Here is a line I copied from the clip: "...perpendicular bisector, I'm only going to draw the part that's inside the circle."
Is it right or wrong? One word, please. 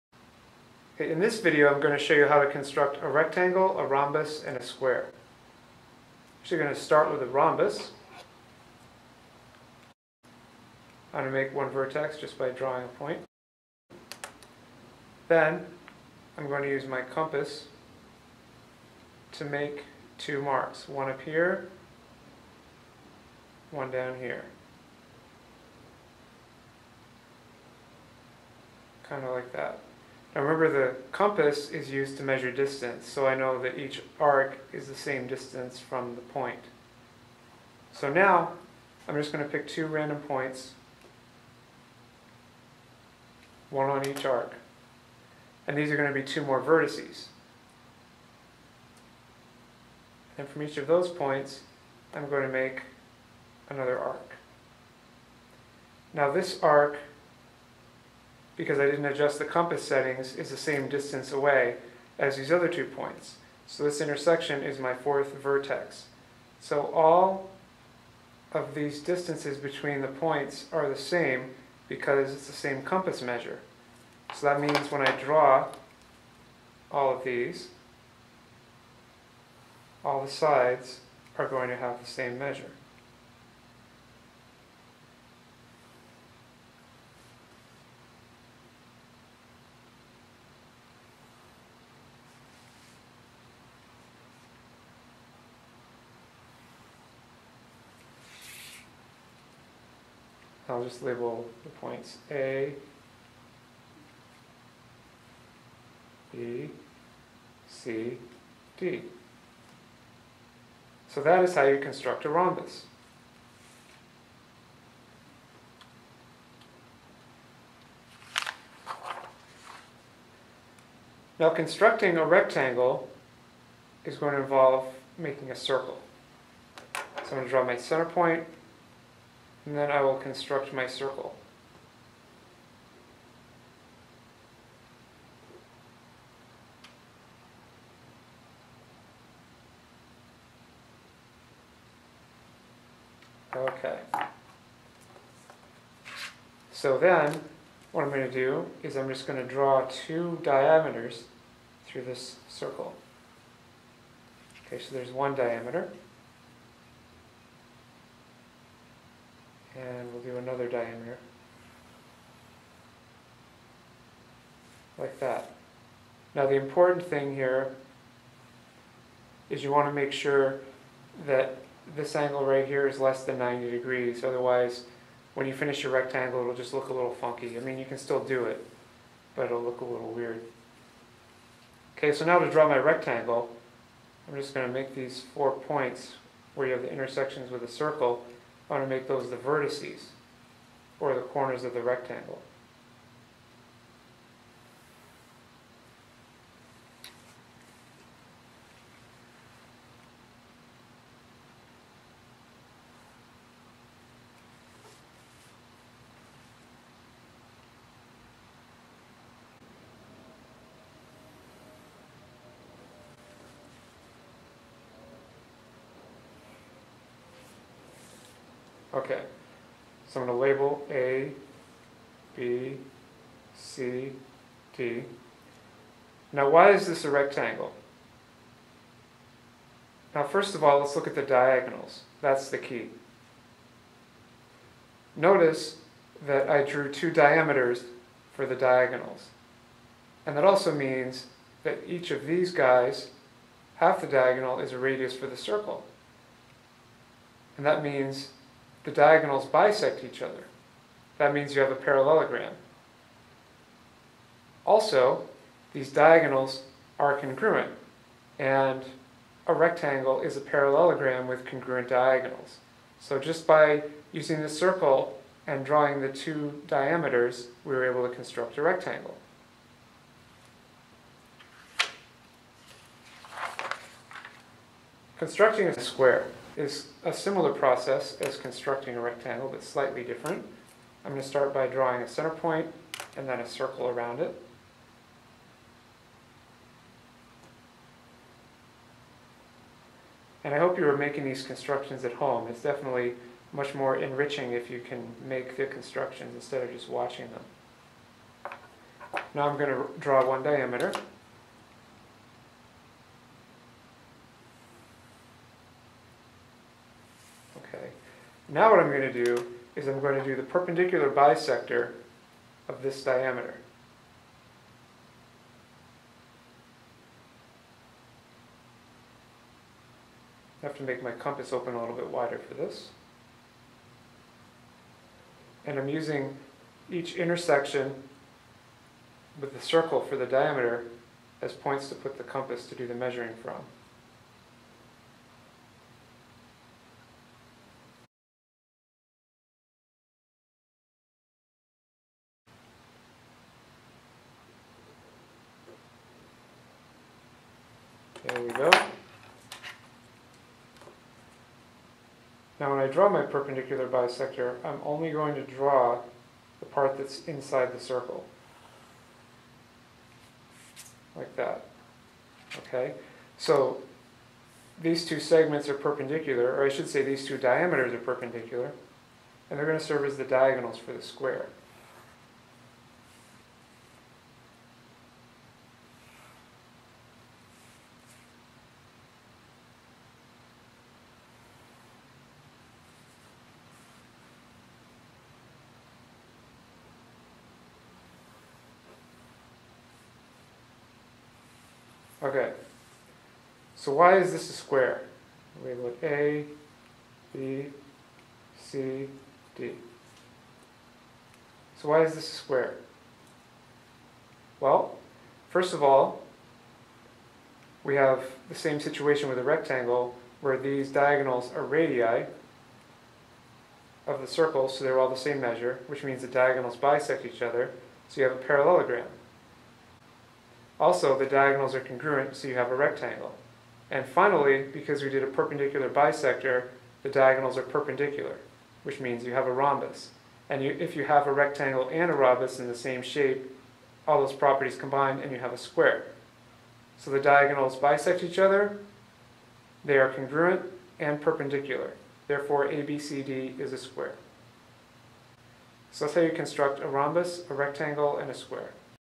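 right.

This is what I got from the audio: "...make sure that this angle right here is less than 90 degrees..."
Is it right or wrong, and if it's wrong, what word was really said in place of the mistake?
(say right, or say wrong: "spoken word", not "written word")
right.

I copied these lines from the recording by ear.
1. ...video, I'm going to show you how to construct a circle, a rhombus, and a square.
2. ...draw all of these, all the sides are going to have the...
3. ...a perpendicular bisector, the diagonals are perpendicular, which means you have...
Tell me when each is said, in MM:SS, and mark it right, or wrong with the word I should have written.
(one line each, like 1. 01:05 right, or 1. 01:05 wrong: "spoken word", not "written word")
1. 00:01 wrong: "rectangle", not "circle"
2. 01:15 right
3. 07:05 right.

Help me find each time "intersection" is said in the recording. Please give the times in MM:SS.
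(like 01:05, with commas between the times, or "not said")
01:03, 03:06, 05:27.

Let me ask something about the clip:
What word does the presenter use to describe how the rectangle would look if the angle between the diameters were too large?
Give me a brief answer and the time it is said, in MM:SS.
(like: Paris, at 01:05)
funky, at 02:57.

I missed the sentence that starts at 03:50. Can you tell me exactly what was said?
Now first of all, let's look at the diagonals.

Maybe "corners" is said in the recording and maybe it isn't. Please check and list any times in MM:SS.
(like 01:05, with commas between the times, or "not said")
03:11.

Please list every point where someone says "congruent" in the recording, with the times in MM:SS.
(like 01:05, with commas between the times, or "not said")
04:17, 04:21, 07:01, 07:20.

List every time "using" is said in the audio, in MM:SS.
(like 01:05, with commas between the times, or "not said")
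04:24, 05:25.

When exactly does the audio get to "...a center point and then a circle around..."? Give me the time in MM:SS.
04:42.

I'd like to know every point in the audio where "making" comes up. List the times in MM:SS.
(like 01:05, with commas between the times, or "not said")
02:05, 04:50.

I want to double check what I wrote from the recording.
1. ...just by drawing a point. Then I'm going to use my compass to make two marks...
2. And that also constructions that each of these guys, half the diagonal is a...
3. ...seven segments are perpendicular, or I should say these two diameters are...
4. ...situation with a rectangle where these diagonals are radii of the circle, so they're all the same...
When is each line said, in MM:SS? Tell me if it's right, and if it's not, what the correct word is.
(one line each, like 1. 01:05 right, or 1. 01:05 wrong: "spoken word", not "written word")
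1. 00:12 right
2. 04:00 wrong: "means", not "constructions"
3. 06:05 wrong: "two", not "seven"
4. 06:48 right.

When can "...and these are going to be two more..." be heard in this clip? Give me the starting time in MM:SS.
00:45.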